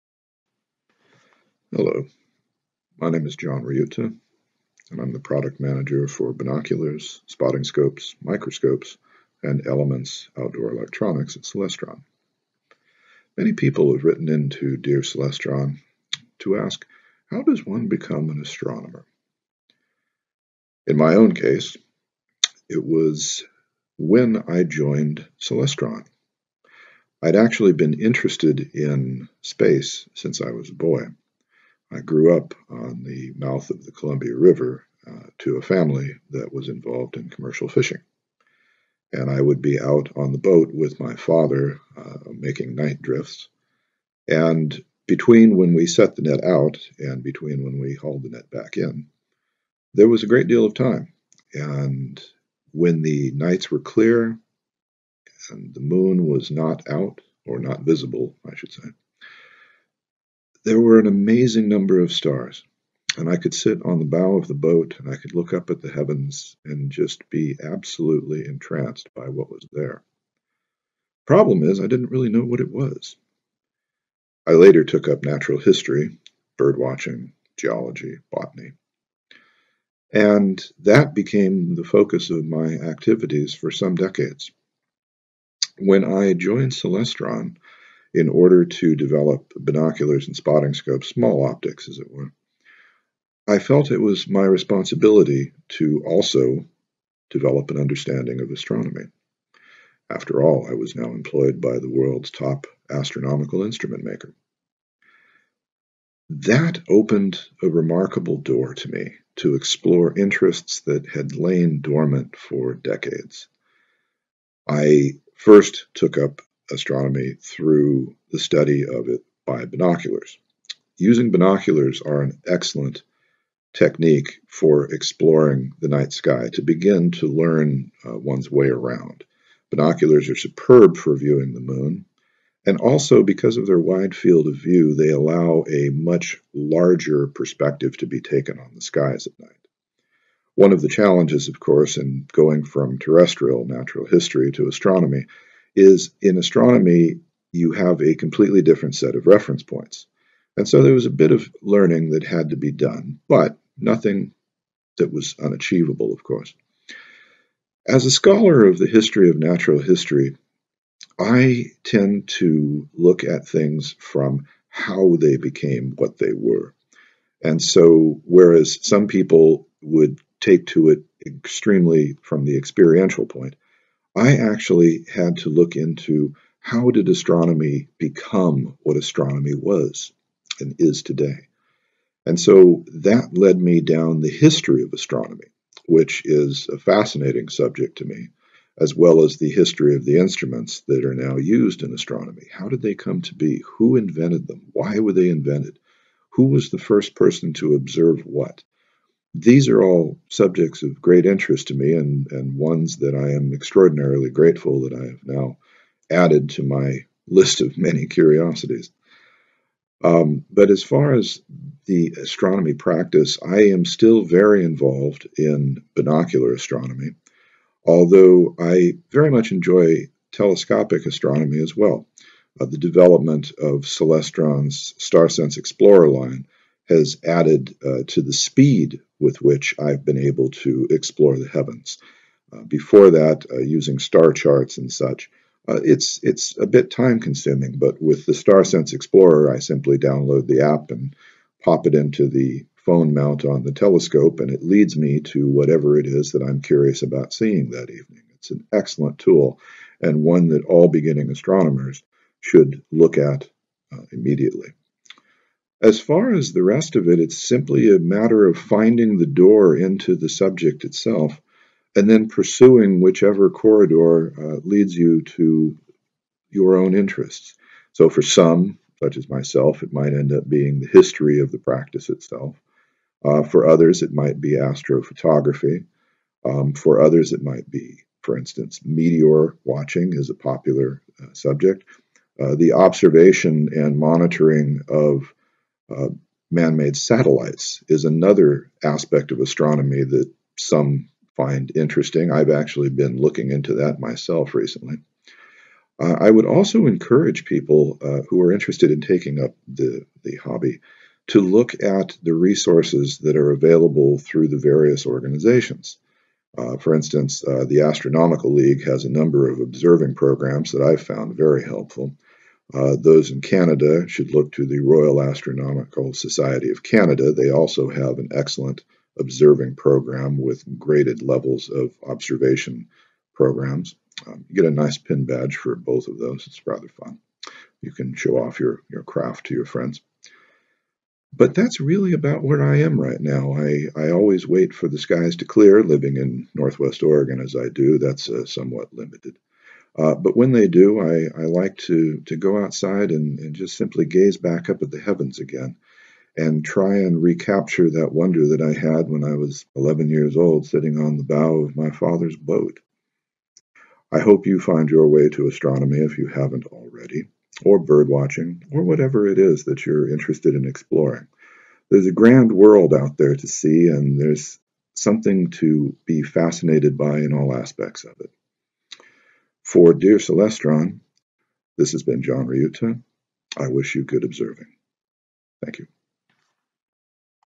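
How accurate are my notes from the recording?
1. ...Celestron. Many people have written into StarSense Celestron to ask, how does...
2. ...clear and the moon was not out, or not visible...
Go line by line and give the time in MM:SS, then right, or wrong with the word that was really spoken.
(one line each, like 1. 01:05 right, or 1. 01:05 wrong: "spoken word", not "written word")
1. 00:11 wrong: "Dear", not "StarSense"
2. 00:53 right.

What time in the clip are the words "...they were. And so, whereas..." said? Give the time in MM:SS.
02:46.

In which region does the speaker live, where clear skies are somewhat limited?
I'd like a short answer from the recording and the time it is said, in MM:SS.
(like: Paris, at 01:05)
Northwest Oregon, at 05:36.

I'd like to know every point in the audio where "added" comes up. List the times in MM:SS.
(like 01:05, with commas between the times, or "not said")
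03:26, 03:47.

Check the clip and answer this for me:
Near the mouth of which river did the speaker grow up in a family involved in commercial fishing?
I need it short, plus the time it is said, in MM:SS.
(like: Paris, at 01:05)
Columbia River, at 00:33.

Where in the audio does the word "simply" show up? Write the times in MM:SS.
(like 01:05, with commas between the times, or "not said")
03:59, 04:17, 05:43.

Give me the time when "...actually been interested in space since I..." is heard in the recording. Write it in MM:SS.
00:27.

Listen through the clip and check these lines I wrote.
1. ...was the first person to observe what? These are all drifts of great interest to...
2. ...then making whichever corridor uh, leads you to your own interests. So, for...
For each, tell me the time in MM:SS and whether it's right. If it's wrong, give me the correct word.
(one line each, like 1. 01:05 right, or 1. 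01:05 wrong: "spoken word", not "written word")
1. 03:16 wrong: "subjects", not "drifts"
2. 04:22 wrong: "pursuing", not "making".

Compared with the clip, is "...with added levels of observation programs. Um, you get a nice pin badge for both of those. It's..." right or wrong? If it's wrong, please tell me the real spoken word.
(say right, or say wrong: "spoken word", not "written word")
wrong: "graded", not "added".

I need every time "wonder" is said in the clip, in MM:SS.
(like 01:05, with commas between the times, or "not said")
05:48.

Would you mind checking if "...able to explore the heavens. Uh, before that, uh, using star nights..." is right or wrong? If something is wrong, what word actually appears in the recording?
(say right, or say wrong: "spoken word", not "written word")
wrong: "charts", not "nights".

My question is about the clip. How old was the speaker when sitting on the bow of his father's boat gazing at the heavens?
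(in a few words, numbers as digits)
11.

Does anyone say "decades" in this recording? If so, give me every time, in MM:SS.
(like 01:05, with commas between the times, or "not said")
01:23, 01:52.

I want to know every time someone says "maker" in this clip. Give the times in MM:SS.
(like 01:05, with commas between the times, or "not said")
01:44.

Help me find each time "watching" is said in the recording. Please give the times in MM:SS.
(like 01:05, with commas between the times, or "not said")
01:16, 04:39, 05:58.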